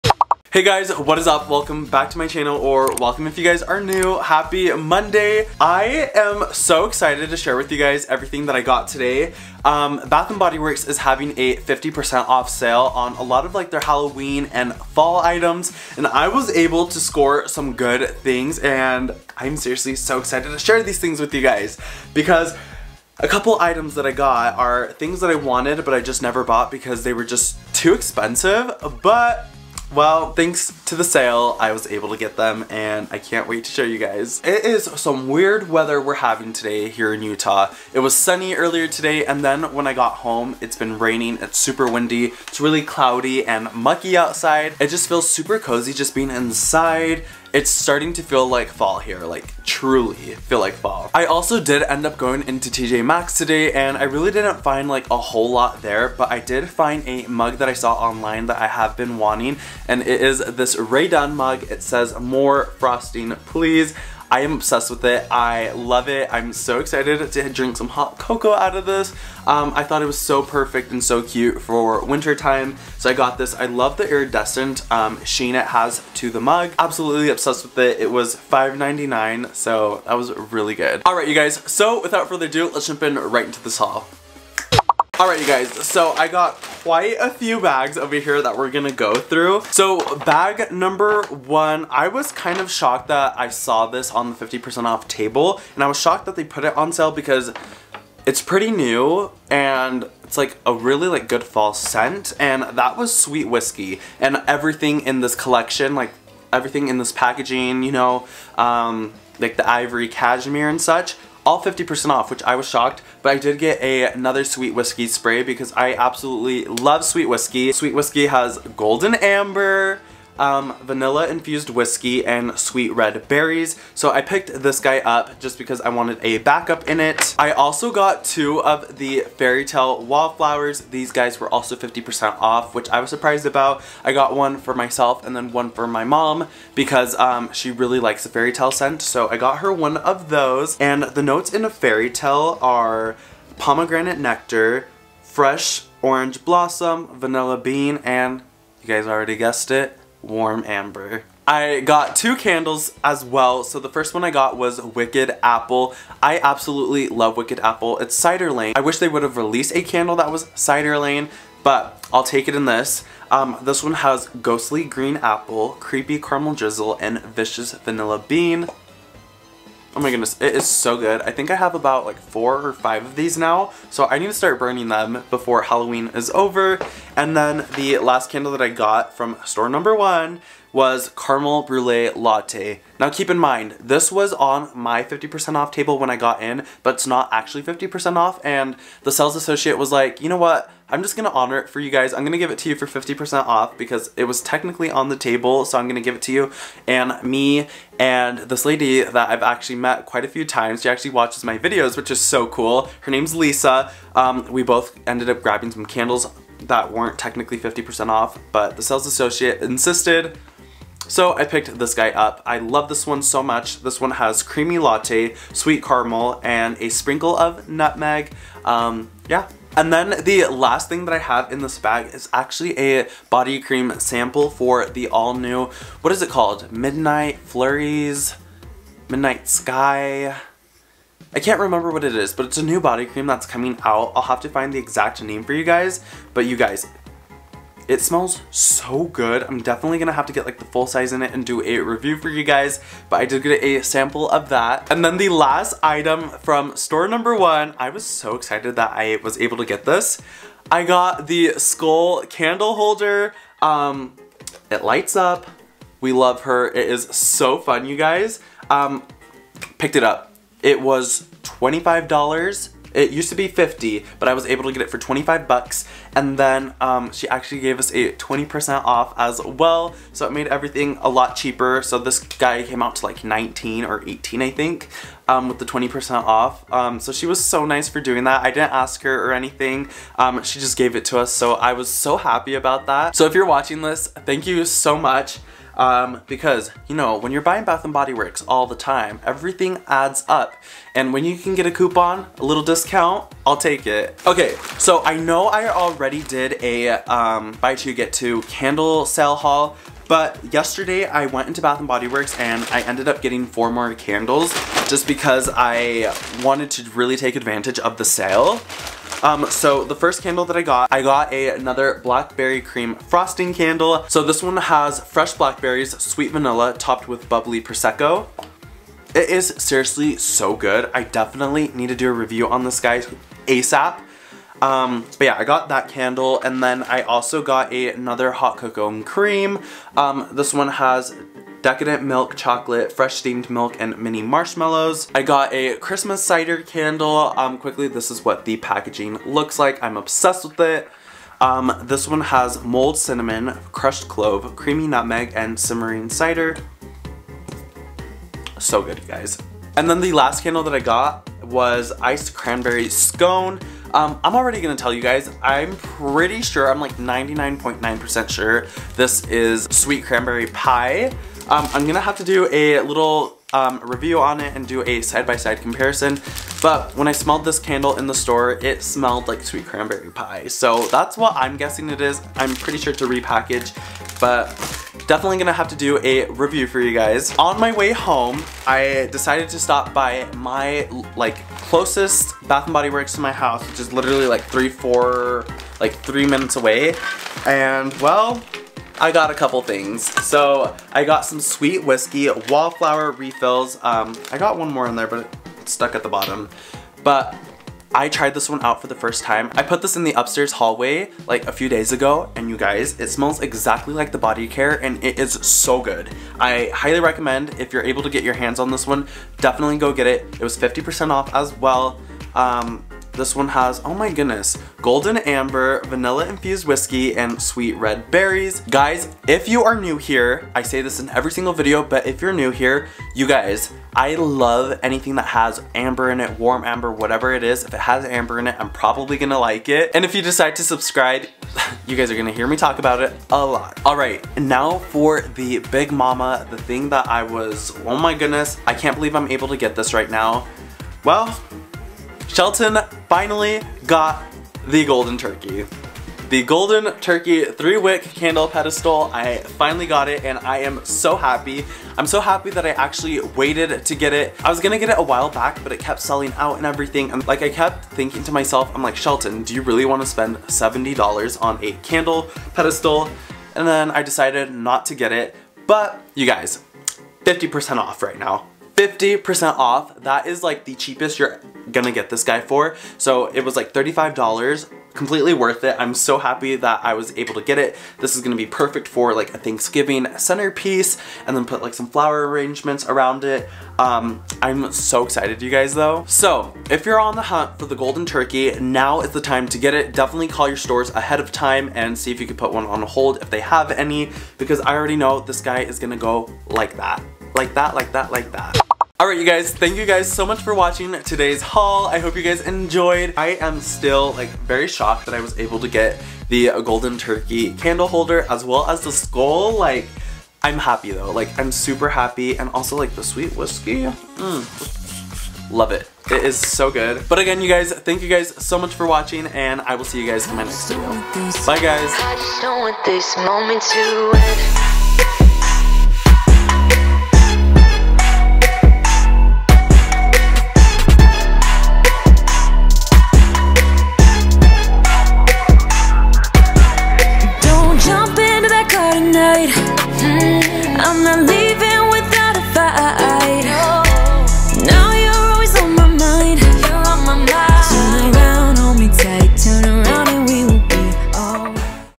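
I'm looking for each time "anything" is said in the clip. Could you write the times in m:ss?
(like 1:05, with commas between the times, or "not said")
4:39, 7:04.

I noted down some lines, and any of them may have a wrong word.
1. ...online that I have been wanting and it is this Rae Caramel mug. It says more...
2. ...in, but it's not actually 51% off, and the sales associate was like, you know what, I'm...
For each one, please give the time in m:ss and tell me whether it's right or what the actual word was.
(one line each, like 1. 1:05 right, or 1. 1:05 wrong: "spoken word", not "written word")
1. 0:57 wrong: "Dunn", not "Caramel"
2. 3:06 wrong: "50", not "51".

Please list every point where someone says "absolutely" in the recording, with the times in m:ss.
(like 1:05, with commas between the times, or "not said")
1:16, 1:55, 2:36.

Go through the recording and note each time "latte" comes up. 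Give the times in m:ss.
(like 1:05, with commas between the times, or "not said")
3:02, 3:34.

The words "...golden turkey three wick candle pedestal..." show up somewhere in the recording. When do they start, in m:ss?
7:26.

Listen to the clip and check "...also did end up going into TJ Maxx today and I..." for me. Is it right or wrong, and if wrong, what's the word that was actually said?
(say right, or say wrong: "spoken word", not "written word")
right.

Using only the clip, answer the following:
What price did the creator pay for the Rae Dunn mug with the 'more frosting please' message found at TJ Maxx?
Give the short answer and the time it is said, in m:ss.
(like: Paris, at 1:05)
$5.99, at 1:18.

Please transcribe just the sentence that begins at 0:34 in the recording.
It is some weird weather we're having today here in Utah.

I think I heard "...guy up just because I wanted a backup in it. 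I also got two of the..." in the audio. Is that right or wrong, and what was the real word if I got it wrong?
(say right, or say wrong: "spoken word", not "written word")
right.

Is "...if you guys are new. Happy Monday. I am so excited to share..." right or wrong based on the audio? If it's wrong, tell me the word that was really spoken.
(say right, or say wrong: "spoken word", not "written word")
right.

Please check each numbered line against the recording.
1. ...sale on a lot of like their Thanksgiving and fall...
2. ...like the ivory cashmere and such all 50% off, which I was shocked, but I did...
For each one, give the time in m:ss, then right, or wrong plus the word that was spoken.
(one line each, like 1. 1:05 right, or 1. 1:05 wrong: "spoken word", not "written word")
1. 0:12 wrong: "Halloween", not "Thanksgiving"
2. 1:49 right.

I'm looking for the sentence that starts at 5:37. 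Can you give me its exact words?
Um, quickly, this is what the packaging looks like.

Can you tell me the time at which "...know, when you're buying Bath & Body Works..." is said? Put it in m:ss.
4:46.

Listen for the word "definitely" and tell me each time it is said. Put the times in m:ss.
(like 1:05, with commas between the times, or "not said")
3:59, 5:21, 6:15, 6:49, 8:09.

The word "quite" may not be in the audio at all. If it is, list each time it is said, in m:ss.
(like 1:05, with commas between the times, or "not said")
1:26, 3:20.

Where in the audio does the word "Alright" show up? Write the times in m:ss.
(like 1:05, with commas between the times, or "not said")
1:25, 8:19.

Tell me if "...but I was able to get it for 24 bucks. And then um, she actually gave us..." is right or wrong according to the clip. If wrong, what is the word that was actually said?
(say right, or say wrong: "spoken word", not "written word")
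wrong: "25", not "24".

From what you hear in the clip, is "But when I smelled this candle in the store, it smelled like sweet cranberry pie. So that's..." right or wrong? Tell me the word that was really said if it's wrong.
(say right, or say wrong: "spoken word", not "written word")
right.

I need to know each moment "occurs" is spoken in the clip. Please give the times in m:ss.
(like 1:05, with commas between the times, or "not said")
not said.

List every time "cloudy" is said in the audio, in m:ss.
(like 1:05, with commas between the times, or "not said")
0:42.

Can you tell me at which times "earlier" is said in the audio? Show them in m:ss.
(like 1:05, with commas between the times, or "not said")
0:38.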